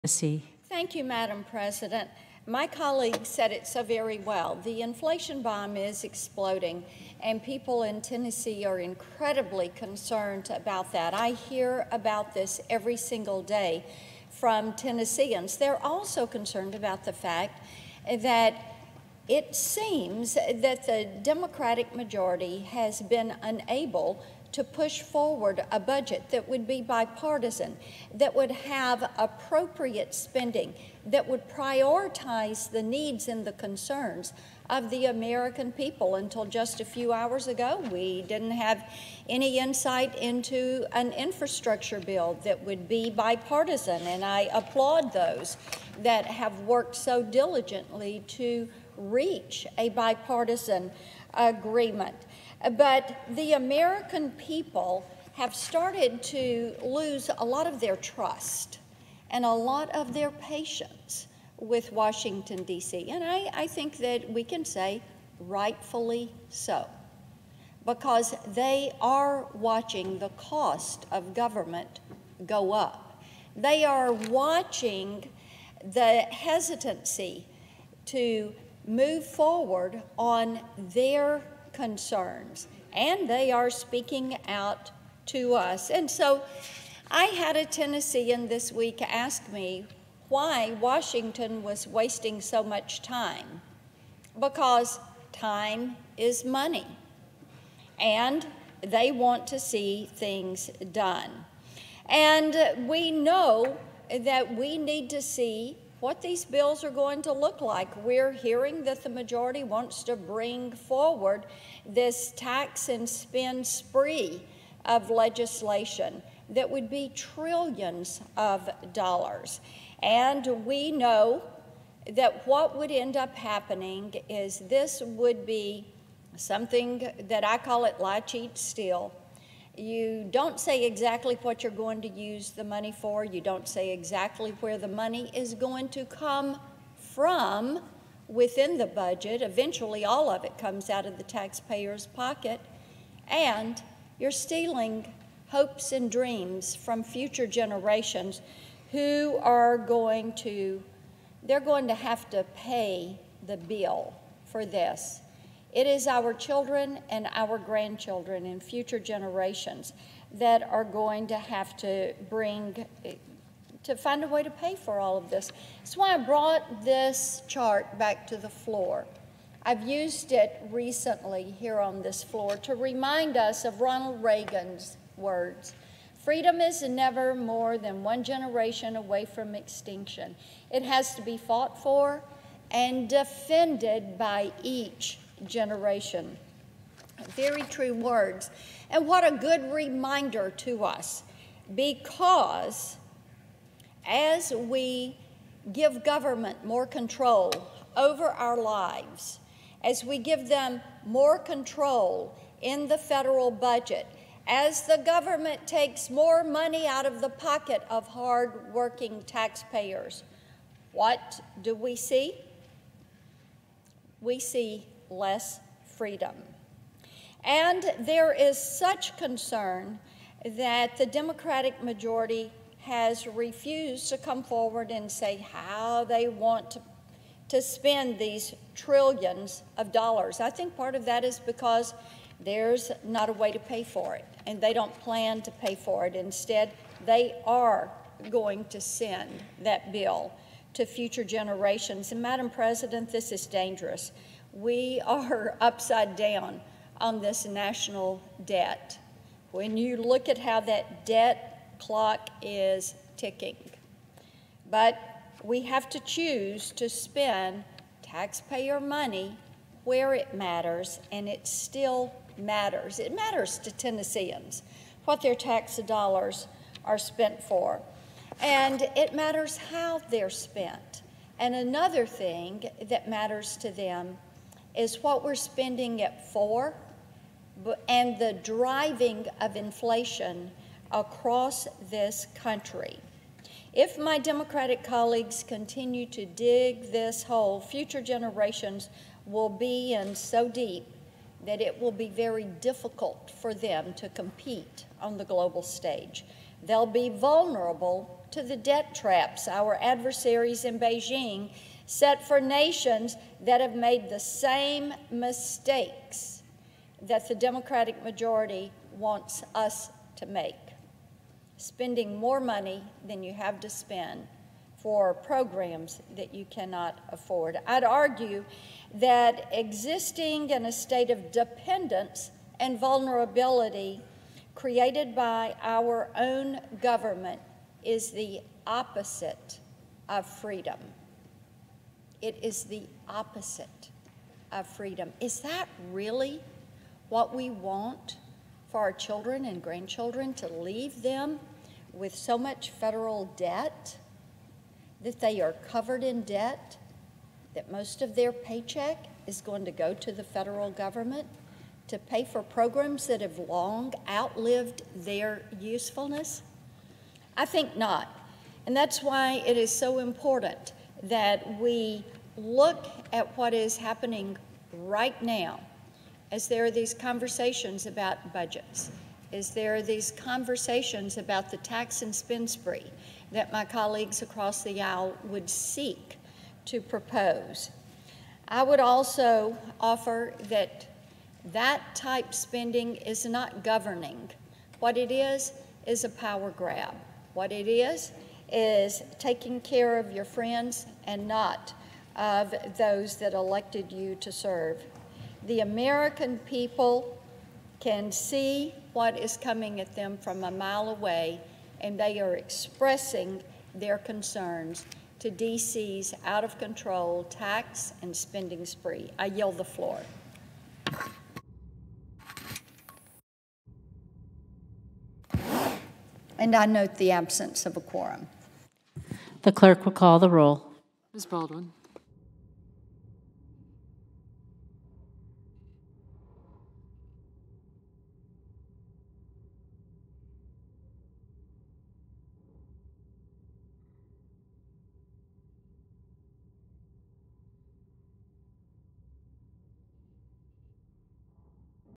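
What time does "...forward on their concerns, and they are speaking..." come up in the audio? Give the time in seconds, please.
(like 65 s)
79 s.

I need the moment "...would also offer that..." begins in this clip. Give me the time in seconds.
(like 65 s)
378 s.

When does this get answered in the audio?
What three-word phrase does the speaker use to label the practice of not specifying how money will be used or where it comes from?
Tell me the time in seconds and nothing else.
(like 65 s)
127 s.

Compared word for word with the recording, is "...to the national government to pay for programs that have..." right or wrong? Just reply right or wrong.
wrong.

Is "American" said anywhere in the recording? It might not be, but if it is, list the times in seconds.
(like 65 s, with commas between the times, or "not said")
35 s, 53 s, 395 s.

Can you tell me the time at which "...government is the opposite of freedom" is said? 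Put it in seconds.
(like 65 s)
326 s.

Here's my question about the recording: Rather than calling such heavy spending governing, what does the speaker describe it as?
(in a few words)
a power grab.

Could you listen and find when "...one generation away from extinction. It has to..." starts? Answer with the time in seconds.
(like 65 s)
178 s.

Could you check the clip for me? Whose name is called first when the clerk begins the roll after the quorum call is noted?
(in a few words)
Ms. Baldwin.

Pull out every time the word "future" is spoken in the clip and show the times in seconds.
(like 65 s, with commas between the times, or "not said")
147 s, 158 s, 240 s, 287 s.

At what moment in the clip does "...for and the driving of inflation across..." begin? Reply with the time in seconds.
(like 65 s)
276 s.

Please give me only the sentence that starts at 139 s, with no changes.
Eventually, all of it comes out of the taxpayer's pocket.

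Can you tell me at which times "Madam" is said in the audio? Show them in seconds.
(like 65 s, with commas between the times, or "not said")
1 s, 242 s.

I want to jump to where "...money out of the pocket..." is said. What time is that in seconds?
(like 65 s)
206 s.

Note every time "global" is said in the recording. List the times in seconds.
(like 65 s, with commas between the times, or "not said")
295 s.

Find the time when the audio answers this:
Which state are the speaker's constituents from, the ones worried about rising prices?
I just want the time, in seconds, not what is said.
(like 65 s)
8 s.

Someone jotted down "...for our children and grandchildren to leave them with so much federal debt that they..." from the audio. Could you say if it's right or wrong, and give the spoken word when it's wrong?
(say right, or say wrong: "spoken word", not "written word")
right.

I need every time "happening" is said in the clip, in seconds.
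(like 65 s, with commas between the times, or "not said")
123 s, 363 s.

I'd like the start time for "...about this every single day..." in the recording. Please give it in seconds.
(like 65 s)
11 s.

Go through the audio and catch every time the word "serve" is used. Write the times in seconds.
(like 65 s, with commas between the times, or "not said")
394 s.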